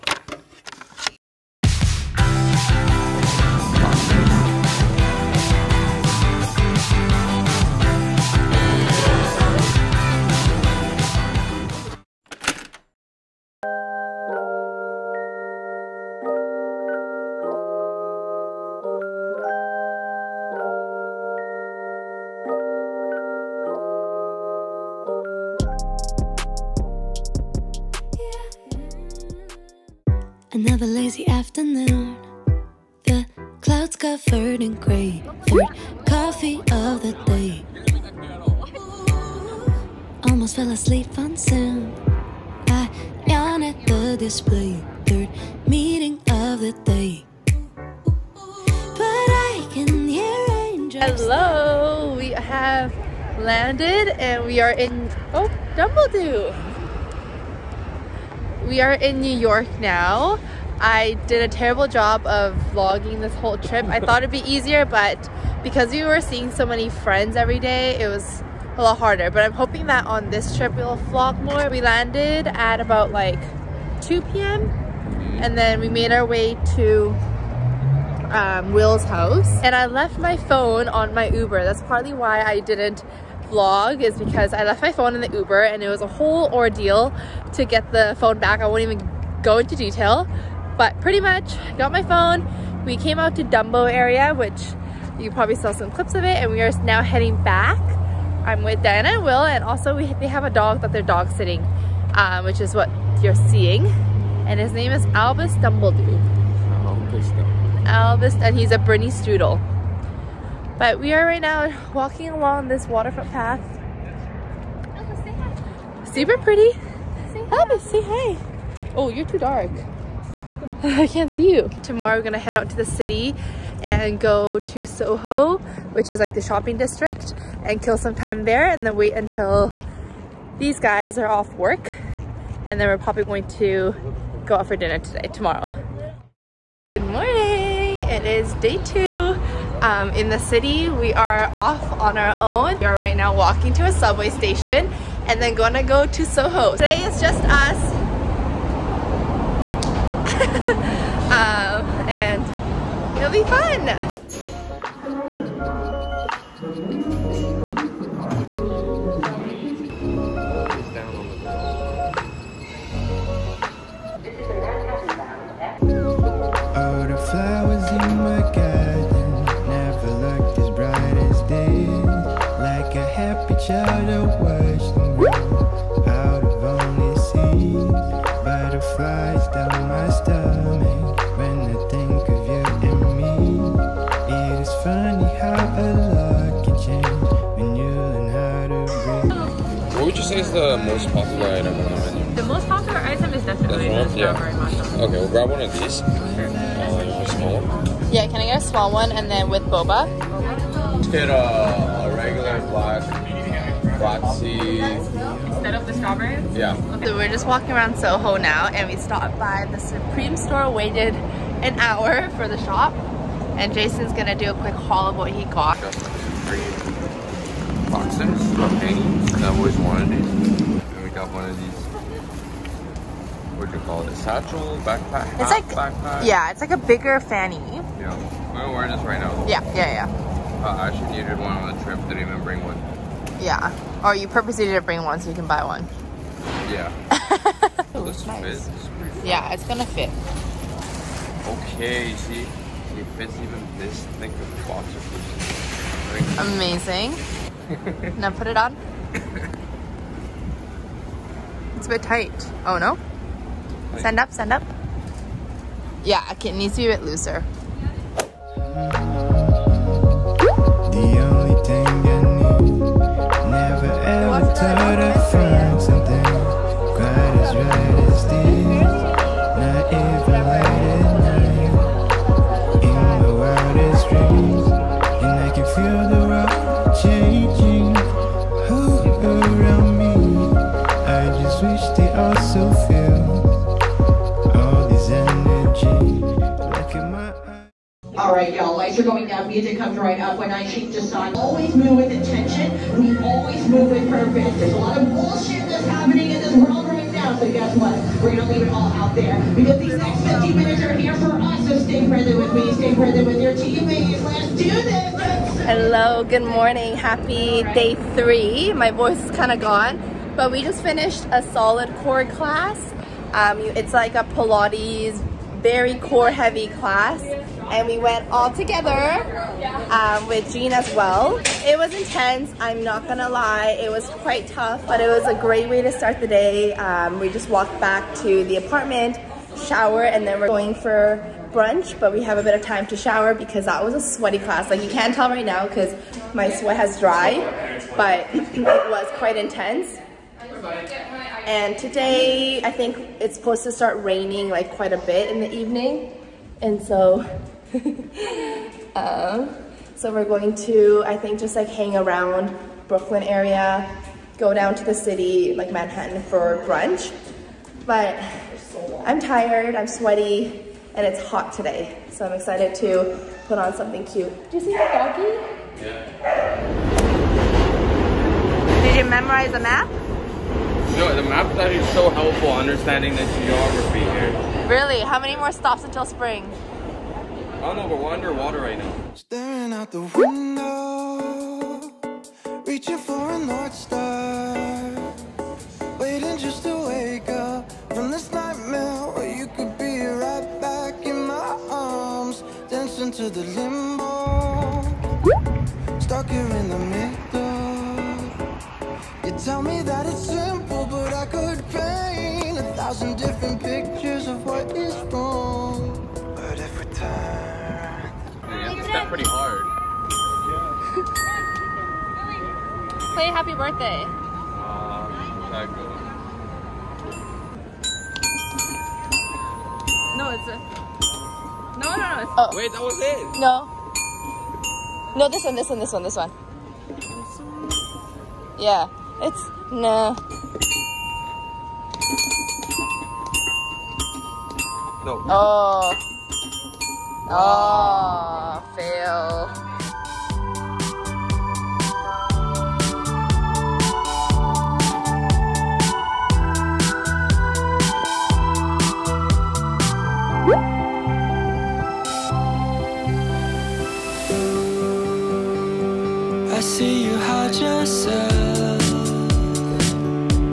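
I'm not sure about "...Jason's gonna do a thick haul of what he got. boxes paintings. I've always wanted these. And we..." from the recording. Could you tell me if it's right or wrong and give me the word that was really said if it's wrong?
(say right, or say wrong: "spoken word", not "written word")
wrong: "quick", not "thick".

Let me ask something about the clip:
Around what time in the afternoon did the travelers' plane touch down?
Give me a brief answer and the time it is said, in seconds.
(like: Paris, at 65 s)
2 p.m., at 74 s.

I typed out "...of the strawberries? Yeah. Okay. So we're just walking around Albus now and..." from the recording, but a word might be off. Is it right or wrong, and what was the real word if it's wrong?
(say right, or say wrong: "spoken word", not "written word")
wrong: "Soho", not "Albus".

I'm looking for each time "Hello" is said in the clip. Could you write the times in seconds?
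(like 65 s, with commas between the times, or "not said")
51 s, 305 s.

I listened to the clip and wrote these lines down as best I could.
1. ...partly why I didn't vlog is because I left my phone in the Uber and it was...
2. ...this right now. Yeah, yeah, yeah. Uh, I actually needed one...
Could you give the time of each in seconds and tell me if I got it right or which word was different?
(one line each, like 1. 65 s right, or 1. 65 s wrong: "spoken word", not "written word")
1. 81 s right
2. 228 s right.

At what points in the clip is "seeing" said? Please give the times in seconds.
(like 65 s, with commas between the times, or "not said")
66 s, 103 s.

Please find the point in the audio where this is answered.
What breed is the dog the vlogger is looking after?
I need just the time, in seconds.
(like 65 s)
108 s.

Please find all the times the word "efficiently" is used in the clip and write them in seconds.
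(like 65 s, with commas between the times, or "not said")
not said.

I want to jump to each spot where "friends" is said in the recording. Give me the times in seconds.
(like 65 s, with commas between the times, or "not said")
66 s.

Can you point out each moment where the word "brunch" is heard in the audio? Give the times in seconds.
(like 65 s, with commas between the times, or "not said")
331 s, 356 s.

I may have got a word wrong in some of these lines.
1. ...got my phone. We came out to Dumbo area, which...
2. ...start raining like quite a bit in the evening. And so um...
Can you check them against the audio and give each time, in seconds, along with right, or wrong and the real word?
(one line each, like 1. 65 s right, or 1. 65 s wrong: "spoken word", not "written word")
1. 91 s right
2. 343 s right.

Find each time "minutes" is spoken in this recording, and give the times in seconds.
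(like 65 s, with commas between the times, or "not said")
300 s.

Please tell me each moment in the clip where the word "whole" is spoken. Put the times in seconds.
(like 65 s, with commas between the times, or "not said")
63 s, 86 s.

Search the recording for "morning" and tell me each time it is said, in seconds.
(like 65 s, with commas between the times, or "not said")
137 s, 306 s.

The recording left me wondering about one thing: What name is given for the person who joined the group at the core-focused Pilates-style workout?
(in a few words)
Jean.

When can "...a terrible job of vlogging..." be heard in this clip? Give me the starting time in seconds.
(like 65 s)
61 s.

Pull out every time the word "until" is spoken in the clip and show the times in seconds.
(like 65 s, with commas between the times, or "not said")
129 s, 375 s.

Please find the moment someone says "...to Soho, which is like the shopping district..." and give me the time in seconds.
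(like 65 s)
124 s.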